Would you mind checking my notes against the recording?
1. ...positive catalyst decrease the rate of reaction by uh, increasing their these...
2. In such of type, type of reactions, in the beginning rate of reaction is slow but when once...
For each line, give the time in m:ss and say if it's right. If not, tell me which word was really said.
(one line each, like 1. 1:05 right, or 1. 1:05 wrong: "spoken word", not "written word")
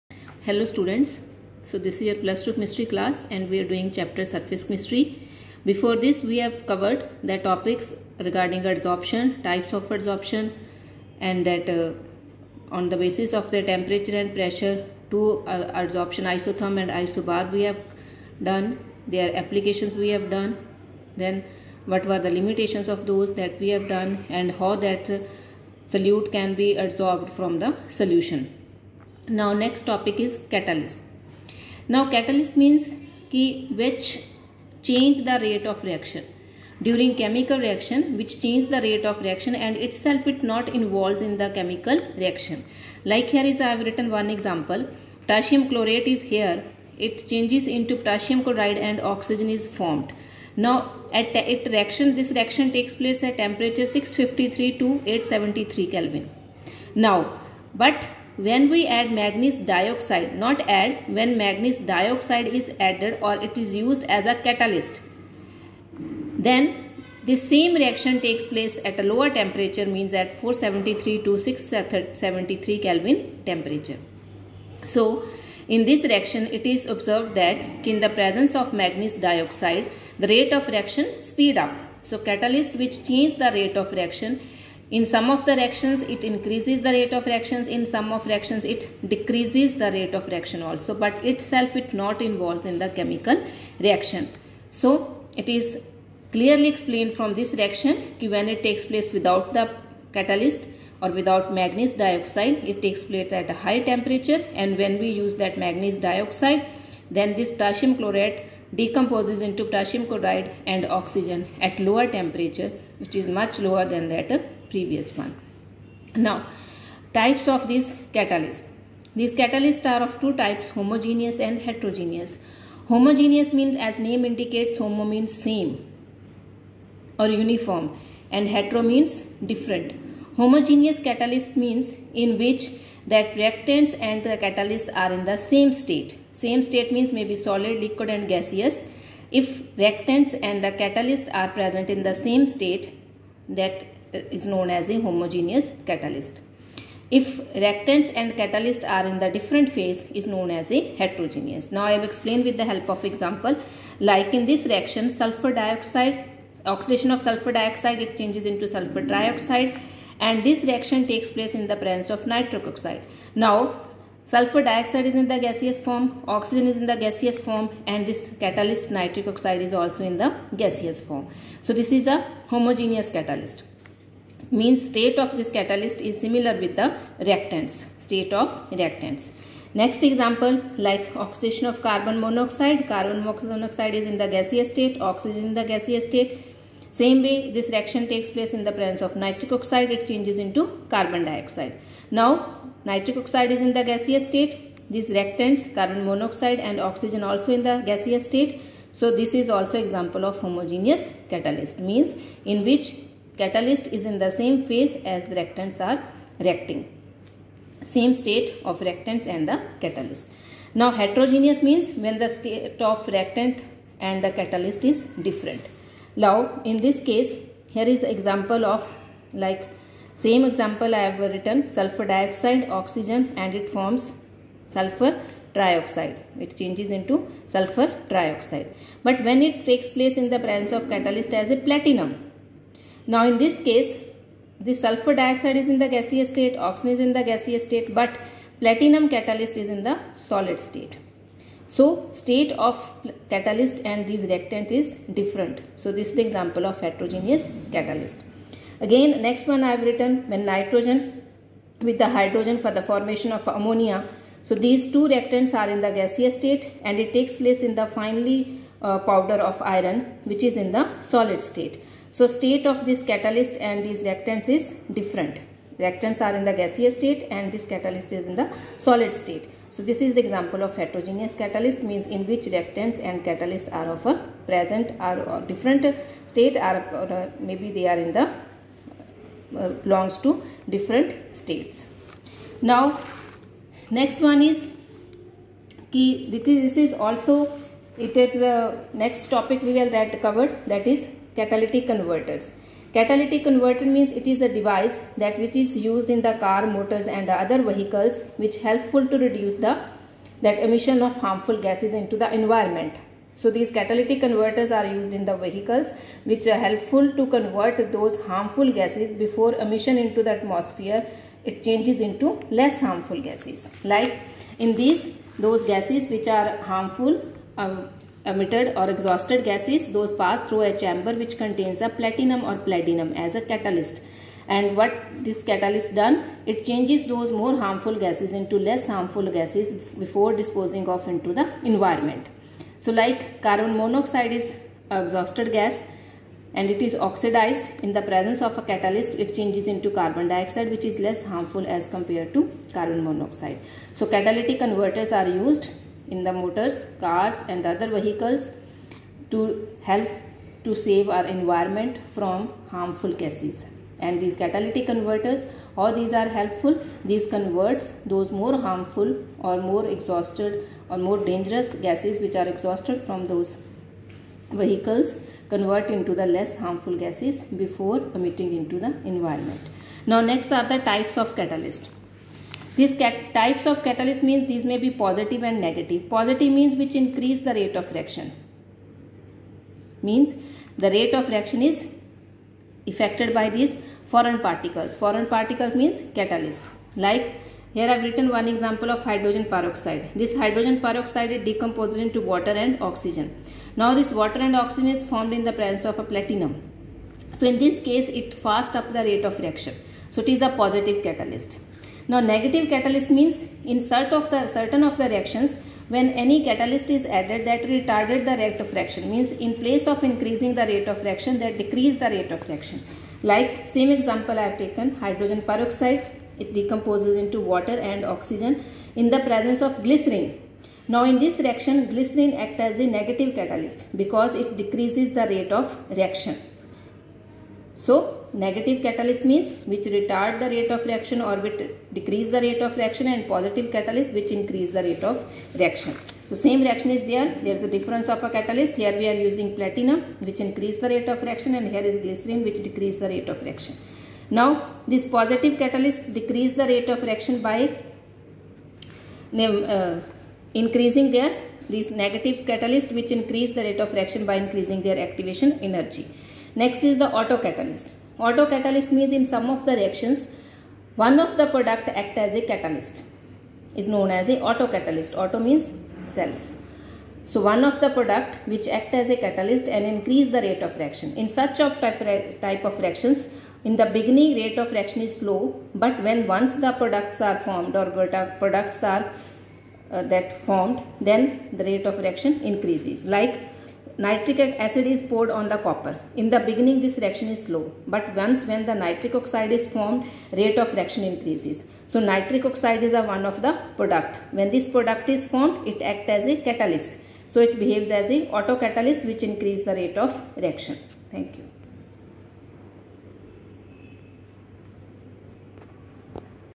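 1. 7:25 right
2. 7:51 right.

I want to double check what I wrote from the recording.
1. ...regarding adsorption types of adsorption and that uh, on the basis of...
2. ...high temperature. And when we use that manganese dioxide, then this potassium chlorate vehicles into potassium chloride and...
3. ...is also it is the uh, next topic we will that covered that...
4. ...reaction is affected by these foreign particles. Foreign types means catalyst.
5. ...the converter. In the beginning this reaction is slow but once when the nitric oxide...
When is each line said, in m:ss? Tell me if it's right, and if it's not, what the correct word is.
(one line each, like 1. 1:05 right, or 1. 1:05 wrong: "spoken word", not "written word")
1. 0:08 right
2. 1:43 wrong: "decomposes", not "vehicles"
3. 4:46 right
4. 6:21 wrong: "particles", not "types"
5. 8:05 wrong: "copper", not "converter".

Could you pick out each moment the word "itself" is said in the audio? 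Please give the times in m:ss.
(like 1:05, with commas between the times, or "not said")
0:39, 1:31.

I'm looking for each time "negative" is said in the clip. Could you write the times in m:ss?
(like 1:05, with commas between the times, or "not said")
6:15, 6:42, 7:02, 7:08, 7:32.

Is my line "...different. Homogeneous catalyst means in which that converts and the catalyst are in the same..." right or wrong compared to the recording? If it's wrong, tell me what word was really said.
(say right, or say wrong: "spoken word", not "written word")
wrong: "reactants", not "converts".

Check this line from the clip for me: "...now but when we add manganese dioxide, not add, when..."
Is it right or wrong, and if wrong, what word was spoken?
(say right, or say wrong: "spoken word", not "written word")
right.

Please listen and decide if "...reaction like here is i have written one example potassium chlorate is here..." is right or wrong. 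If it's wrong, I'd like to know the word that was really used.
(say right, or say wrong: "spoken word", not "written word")
right.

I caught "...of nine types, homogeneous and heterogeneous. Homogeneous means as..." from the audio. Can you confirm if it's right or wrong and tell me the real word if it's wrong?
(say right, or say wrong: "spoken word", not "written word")
wrong: "two", not "nine".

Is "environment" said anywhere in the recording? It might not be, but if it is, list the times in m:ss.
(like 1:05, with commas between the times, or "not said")
5:02, 5:31, 5:51, 6:09.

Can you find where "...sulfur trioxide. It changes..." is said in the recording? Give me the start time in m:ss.
3:44.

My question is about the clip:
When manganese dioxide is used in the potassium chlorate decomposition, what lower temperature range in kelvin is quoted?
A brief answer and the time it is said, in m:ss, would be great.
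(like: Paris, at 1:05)
473 to 673 K, at 1:10.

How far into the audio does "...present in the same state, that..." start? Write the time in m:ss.
2:21.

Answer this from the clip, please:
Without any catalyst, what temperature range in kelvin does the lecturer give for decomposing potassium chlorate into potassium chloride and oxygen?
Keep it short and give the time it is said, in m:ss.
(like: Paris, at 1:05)
653 to 873 K, at 0:53.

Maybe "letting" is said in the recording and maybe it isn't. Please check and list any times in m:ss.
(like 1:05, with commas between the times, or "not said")
not said.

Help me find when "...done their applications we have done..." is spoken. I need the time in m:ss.
0:18.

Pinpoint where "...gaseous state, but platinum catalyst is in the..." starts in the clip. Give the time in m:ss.
3:57.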